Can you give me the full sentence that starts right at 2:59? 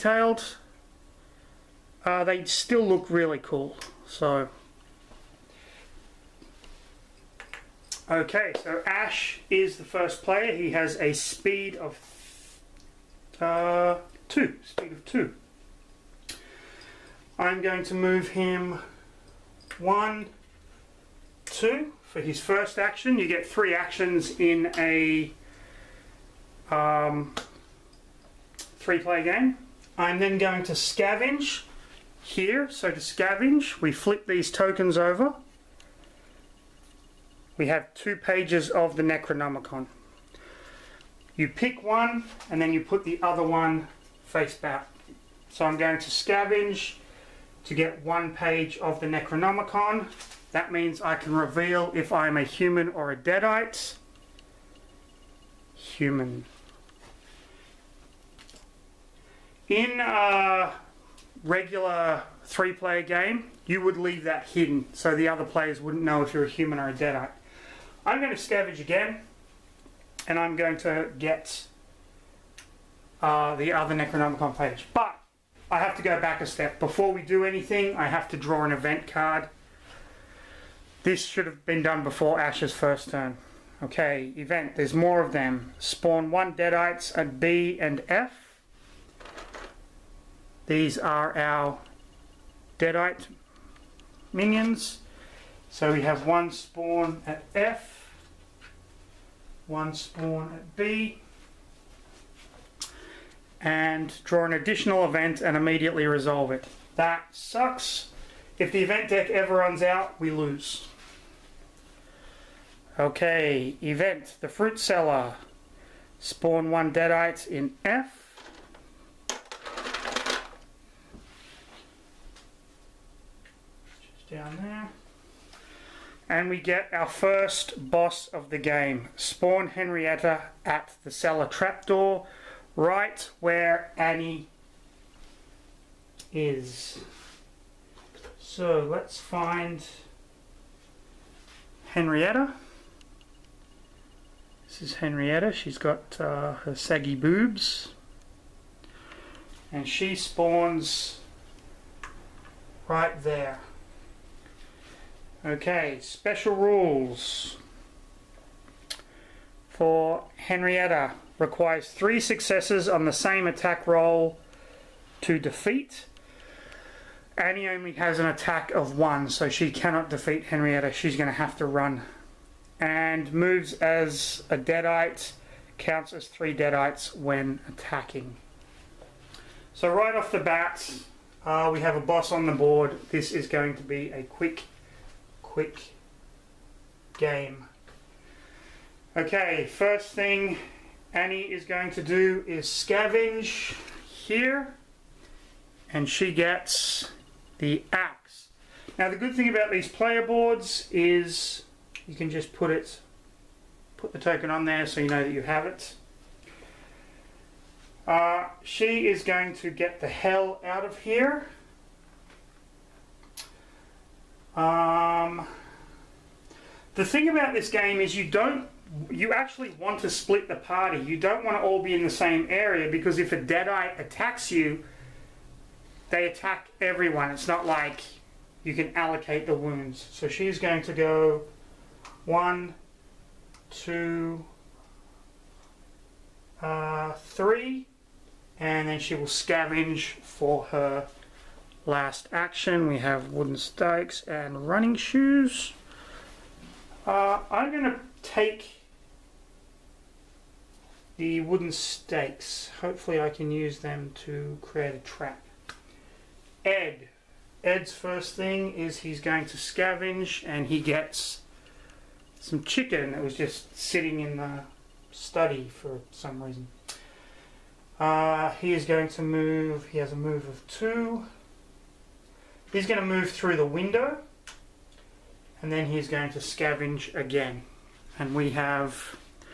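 So, right off the bat, uh, we have a boss on the board.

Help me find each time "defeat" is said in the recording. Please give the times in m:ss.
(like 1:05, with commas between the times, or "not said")
2:45, 2:50.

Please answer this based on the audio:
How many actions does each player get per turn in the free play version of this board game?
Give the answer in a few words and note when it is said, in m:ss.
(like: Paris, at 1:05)
3, at 0:23.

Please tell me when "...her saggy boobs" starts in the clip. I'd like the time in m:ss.
2:26.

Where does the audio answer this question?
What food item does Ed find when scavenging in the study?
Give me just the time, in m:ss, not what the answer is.
4:22.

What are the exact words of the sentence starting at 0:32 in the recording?
So to scavenge, we flip these tokens over.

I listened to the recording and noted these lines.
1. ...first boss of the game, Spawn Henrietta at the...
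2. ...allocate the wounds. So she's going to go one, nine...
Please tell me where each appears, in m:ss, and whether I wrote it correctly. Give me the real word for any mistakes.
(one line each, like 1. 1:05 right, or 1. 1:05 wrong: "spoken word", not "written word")
1. 2:07 right
2. 3:48 wrong: "two", not "nine".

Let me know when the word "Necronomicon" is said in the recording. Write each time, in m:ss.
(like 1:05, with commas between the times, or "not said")
0:39, 0:49, 1:13.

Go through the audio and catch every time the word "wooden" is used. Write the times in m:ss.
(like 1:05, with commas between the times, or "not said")
4:03, 4:11.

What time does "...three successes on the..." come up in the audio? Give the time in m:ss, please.
2:41.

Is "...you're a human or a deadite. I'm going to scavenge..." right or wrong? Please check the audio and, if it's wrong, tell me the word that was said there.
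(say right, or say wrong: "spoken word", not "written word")
right.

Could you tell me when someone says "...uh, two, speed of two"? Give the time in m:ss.
0:13.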